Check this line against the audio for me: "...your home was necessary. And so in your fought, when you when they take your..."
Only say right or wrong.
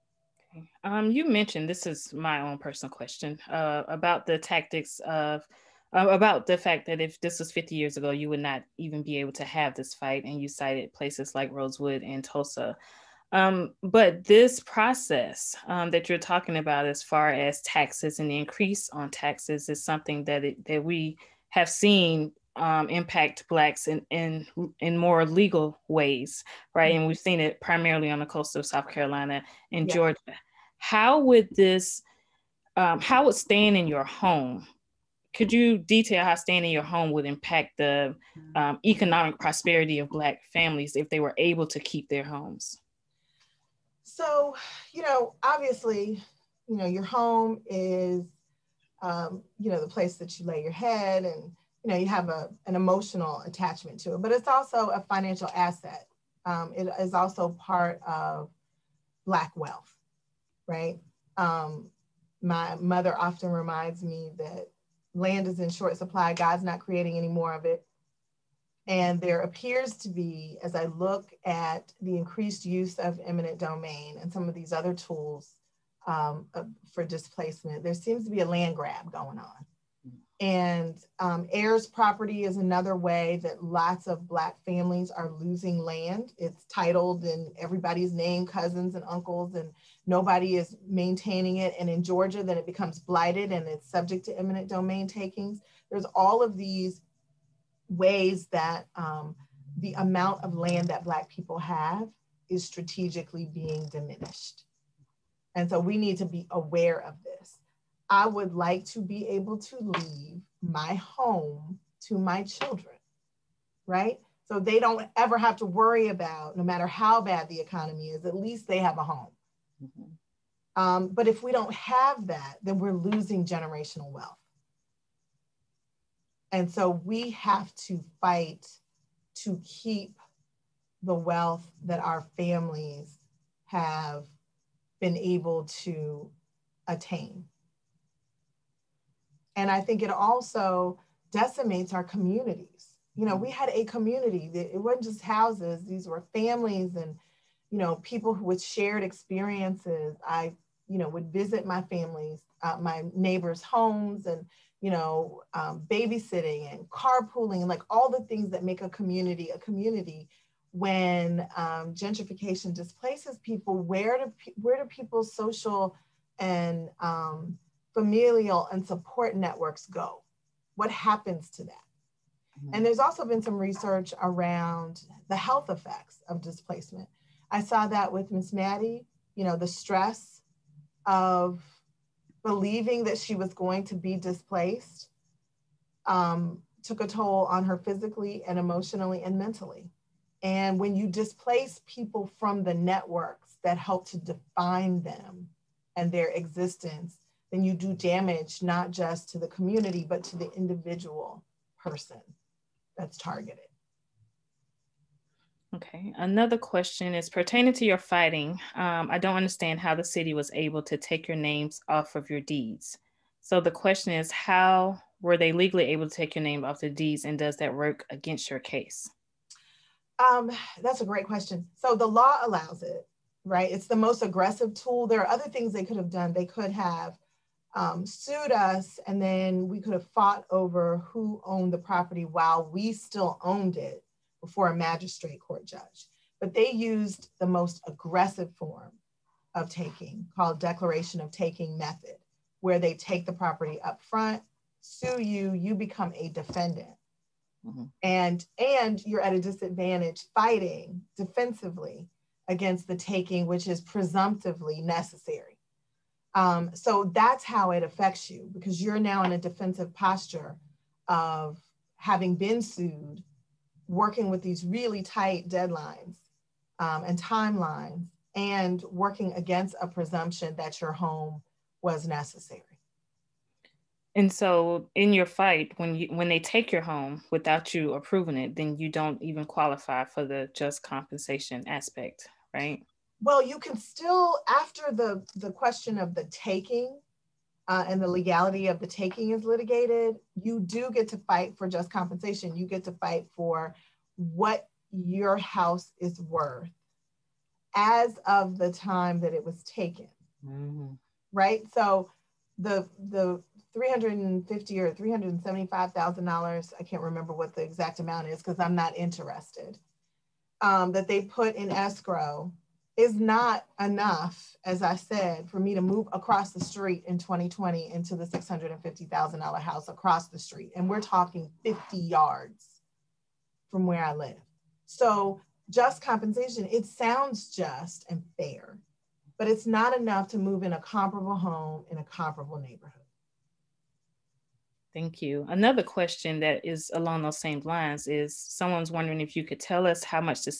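wrong.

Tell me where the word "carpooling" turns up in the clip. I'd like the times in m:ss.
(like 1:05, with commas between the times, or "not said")
2:36.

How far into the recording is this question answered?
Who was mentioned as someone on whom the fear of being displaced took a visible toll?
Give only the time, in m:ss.
2:58.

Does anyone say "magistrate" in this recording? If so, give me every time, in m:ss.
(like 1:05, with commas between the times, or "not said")
3:54.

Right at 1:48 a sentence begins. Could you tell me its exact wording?
I would like to be able to leave my home to my children, right?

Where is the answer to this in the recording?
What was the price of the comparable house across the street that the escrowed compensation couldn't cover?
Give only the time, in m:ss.
5:18.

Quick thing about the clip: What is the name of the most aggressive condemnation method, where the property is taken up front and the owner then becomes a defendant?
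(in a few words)
Declaration of taking.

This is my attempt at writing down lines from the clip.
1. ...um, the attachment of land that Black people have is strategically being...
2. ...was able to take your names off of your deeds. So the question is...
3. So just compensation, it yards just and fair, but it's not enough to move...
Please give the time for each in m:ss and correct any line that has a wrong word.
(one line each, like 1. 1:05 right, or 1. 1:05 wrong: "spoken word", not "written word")
1. 1:38 wrong: "amount", not "attachment"
2. 3:30 right
3. 5:24 wrong: "sounds", not "yards".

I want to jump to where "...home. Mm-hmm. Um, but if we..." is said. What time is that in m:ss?
1:59.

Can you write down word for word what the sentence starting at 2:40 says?
When um, gentrification displaces people, where do where do people's social and um, familial and support networks go?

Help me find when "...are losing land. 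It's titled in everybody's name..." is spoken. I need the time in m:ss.
1:25.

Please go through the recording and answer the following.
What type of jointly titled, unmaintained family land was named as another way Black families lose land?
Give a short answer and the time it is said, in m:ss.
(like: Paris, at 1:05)
Heirs property, at 1:21.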